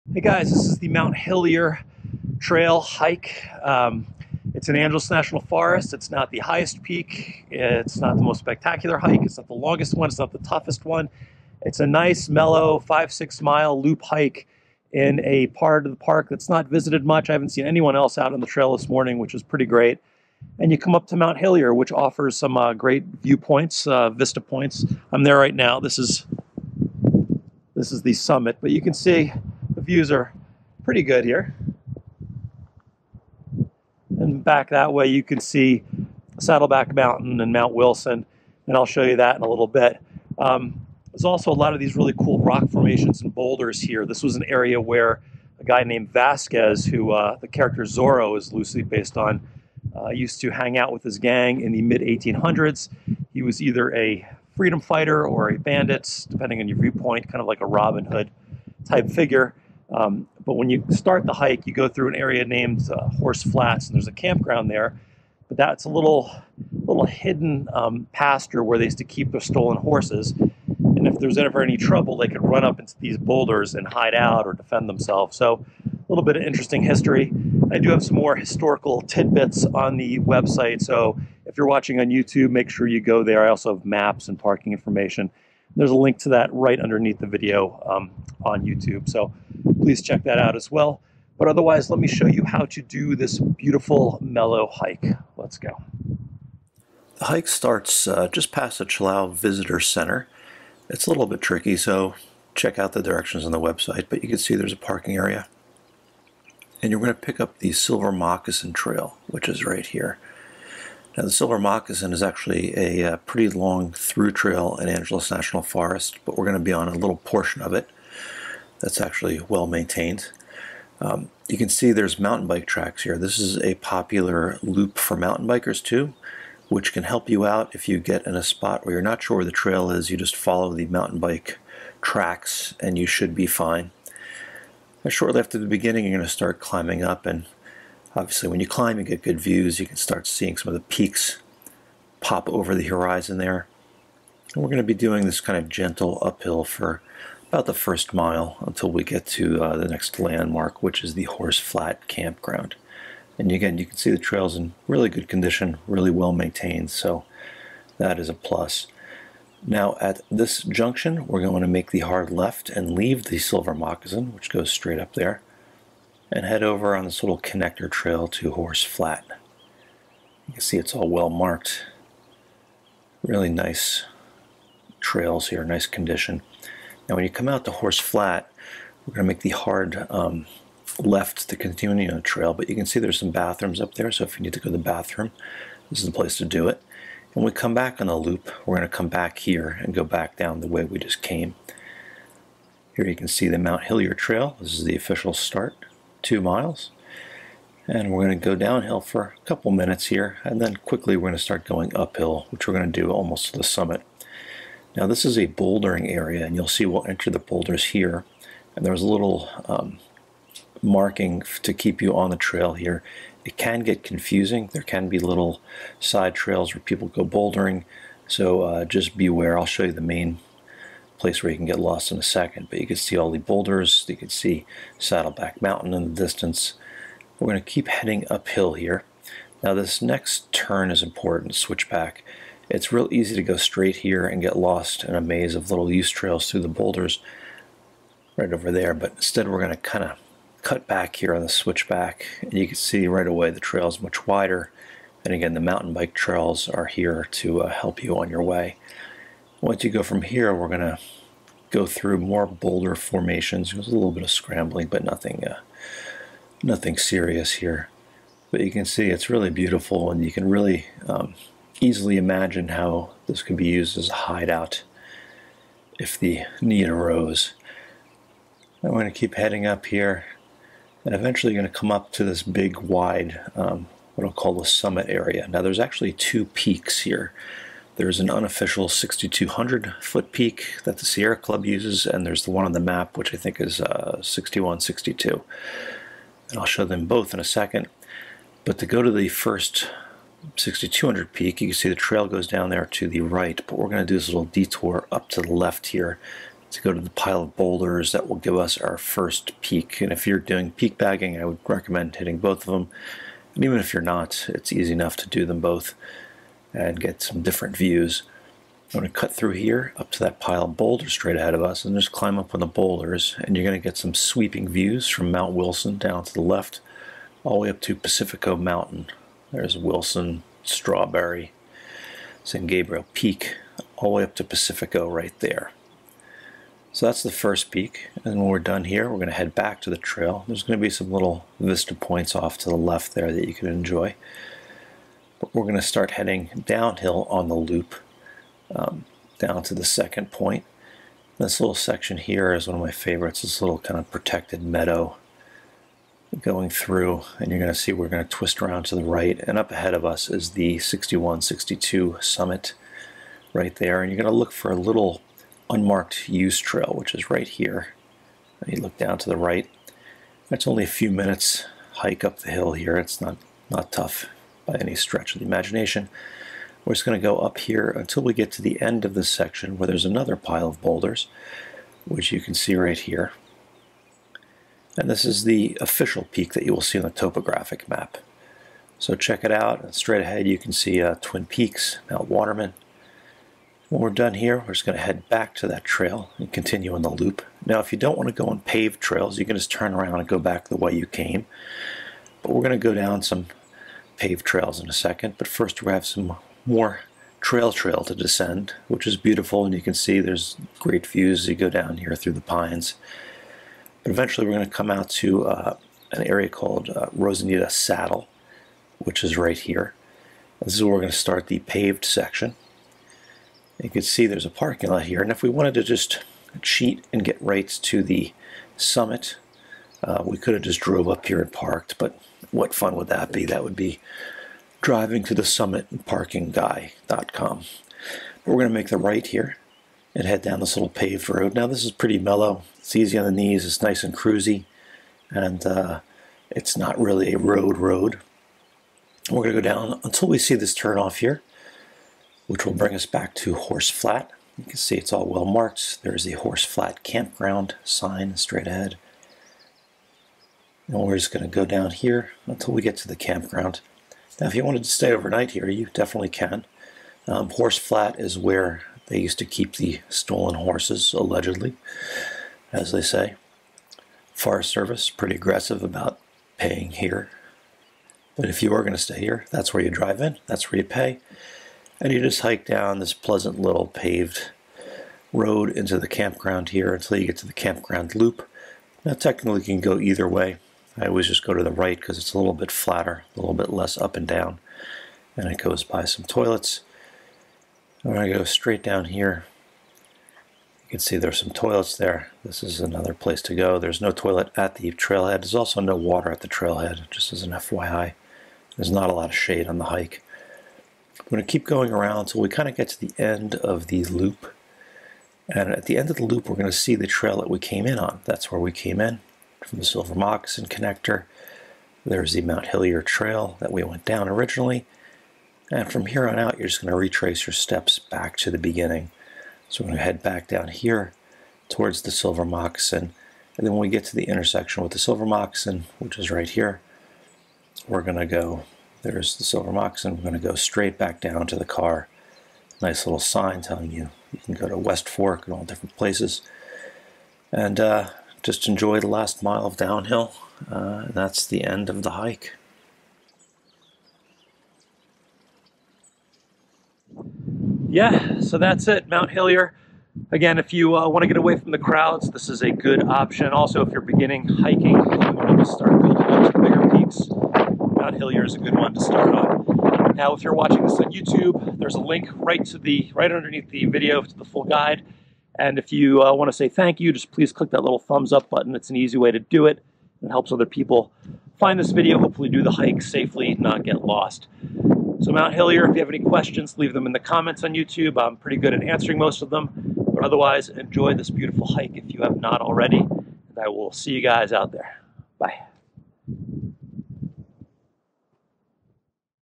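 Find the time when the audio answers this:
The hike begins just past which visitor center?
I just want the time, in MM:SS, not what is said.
01:38.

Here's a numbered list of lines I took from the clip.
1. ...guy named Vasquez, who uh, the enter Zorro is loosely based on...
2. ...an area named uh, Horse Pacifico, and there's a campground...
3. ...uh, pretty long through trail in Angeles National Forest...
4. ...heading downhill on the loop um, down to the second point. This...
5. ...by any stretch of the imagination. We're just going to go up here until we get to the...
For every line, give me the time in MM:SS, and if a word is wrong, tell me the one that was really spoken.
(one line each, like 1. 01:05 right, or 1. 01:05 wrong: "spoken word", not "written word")
1. 00:45 wrong: "character", not "enter"
2. 01:02 wrong: "Flats", not "Pacifico"
3. 01:53 right
4. 05:36 right
5. 06:04 right.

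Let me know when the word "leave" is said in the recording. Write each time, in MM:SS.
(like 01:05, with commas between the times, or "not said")
02:42, 09:36.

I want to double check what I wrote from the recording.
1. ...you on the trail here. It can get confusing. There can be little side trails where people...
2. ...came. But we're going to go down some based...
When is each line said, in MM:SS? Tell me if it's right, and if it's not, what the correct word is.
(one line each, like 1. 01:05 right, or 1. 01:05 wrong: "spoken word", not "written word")
1. 03:32 right
2. 06:31 wrong: "paved", not "based".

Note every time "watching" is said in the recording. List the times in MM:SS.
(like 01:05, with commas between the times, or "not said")
01:21, 09:20.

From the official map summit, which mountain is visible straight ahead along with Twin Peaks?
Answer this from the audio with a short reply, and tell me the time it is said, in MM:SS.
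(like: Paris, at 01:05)
Mount Waterman, at 06:22.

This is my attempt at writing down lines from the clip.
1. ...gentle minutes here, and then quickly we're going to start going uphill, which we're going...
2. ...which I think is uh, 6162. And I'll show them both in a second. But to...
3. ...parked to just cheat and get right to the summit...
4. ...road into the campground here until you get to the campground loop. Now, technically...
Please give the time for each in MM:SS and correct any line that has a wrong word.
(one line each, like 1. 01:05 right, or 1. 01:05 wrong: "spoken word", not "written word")
1. 03:19 wrong: "couple", not "gentle"
2. 04:43 right
3. 06:55 wrong: "wanted", not "parked"
4. 07:55 right.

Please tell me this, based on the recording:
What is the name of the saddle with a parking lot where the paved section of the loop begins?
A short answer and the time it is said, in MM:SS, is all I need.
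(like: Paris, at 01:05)
Rosenita Saddle, at 06:47.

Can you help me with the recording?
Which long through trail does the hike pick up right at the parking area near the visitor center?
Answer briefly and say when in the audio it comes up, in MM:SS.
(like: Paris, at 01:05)
Silver Moccasin Trail, at 01:47.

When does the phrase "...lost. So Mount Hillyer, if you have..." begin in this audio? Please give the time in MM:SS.
09:34.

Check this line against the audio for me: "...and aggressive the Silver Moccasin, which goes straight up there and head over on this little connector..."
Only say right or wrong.
wrong.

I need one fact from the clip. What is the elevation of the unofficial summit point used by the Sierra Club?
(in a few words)
6,200 feet.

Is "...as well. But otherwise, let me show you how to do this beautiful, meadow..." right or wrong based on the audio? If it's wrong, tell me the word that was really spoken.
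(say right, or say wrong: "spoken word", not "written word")
wrong: "mellow", not "meadow".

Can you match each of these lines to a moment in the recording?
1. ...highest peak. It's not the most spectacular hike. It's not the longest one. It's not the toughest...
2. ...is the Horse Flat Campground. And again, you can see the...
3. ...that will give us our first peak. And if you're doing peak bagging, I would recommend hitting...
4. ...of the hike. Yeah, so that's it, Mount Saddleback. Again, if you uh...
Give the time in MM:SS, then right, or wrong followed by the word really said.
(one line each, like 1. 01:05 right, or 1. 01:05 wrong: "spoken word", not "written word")
1. 00:06 right
2. 02:31 right
3. 04:58 right
4. 09:01 wrong: "Hillyer", not "Saddleback".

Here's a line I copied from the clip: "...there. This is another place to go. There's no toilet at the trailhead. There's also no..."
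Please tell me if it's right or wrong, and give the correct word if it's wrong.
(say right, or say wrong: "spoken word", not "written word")
right.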